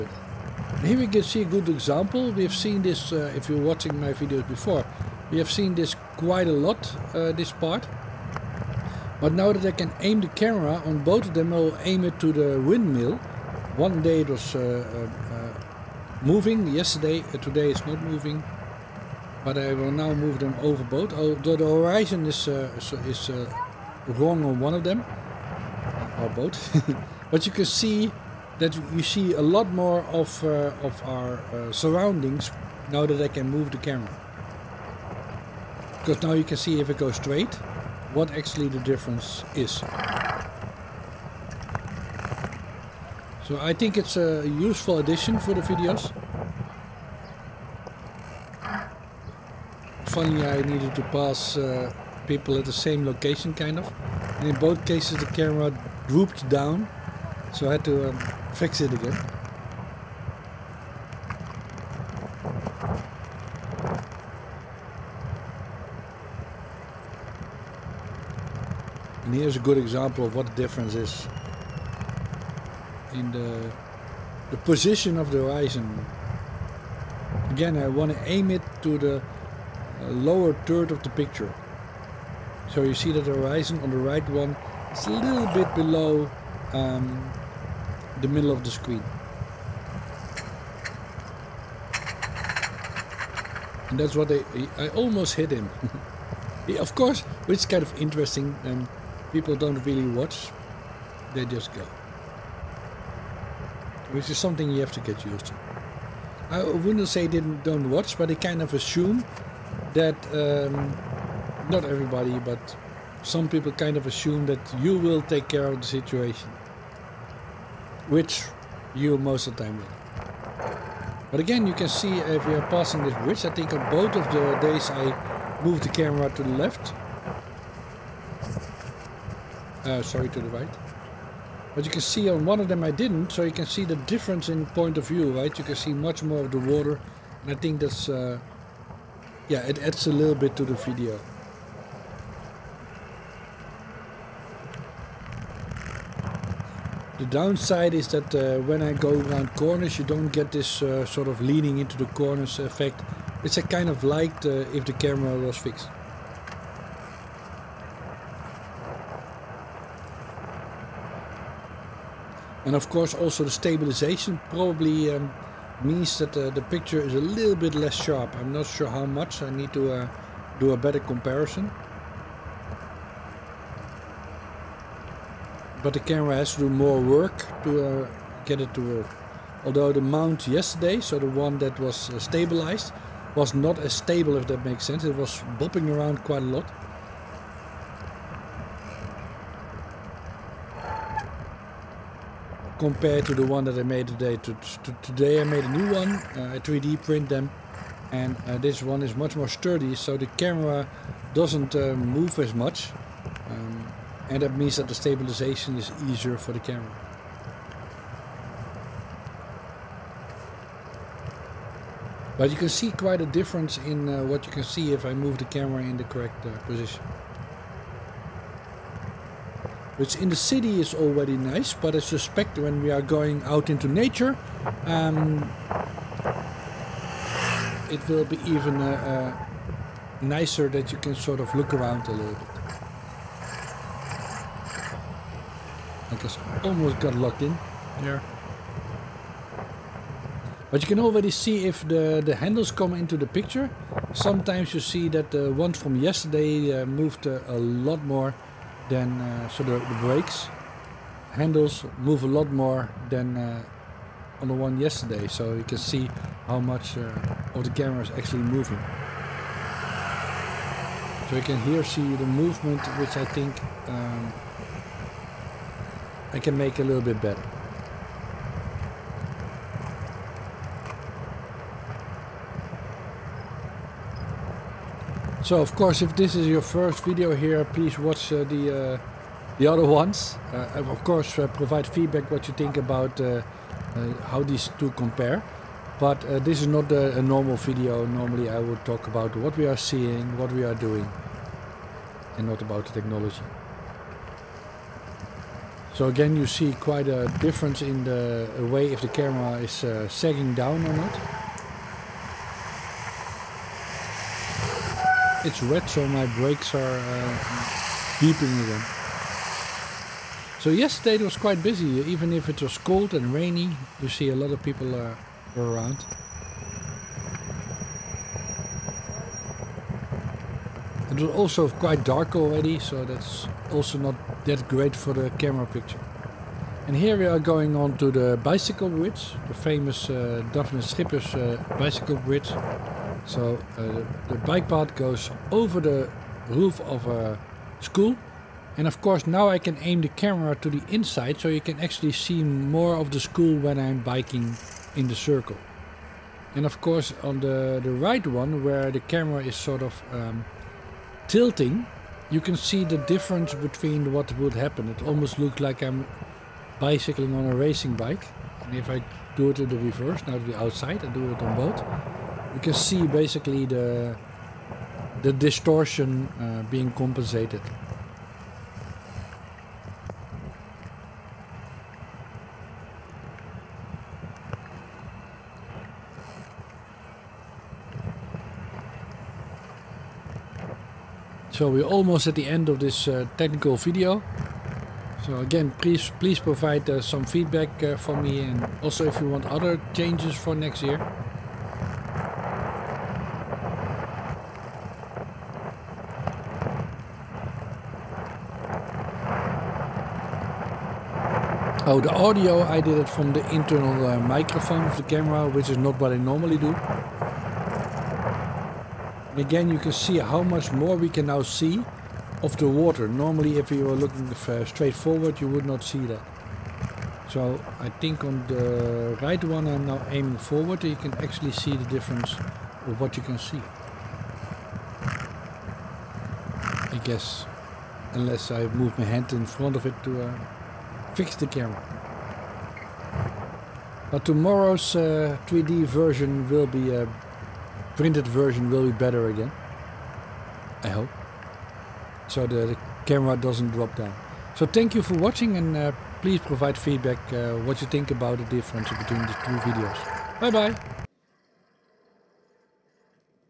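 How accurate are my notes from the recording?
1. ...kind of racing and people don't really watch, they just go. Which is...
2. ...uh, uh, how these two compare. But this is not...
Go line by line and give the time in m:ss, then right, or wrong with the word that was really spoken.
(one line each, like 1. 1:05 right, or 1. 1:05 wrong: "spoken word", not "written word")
1. 1:37 wrong: "interesting", not "racing"
2. 4:43 right.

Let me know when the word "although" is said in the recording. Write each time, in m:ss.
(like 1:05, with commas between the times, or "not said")
0:21, 2:59.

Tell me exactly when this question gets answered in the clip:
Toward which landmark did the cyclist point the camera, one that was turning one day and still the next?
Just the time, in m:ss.
0:12.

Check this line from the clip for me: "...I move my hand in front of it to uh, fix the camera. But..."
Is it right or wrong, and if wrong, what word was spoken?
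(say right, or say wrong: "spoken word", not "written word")
right.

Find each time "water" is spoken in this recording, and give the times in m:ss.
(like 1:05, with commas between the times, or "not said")
2:16, 6:52.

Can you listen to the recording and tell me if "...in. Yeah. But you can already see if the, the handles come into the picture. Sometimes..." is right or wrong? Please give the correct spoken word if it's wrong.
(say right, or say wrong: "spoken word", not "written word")
right.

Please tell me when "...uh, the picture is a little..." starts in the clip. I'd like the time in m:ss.
2:46.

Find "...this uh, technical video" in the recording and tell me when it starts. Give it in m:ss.
6:22.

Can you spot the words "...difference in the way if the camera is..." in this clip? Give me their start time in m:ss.
4:57.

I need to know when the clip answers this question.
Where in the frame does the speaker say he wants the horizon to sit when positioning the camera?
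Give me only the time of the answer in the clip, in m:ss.
1:20.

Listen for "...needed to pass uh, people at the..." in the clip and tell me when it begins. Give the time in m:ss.
0:50.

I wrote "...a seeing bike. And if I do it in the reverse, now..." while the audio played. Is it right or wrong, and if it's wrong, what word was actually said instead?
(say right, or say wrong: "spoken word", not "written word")
wrong: "racing", not "seeing".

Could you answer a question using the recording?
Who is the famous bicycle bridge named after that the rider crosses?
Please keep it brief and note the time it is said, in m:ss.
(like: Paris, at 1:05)
Dafne Schippers, at 5:30.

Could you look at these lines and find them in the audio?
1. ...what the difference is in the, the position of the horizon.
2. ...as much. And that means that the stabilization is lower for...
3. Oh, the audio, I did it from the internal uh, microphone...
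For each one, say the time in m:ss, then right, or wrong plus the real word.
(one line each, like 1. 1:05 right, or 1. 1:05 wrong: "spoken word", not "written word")
1. 1:10 right
2. 3:22 wrong: "easier", not "lower"
3. 6:41 right.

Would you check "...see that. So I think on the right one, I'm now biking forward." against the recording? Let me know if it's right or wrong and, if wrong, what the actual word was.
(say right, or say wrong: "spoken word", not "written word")
wrong: "aiming", not "biking".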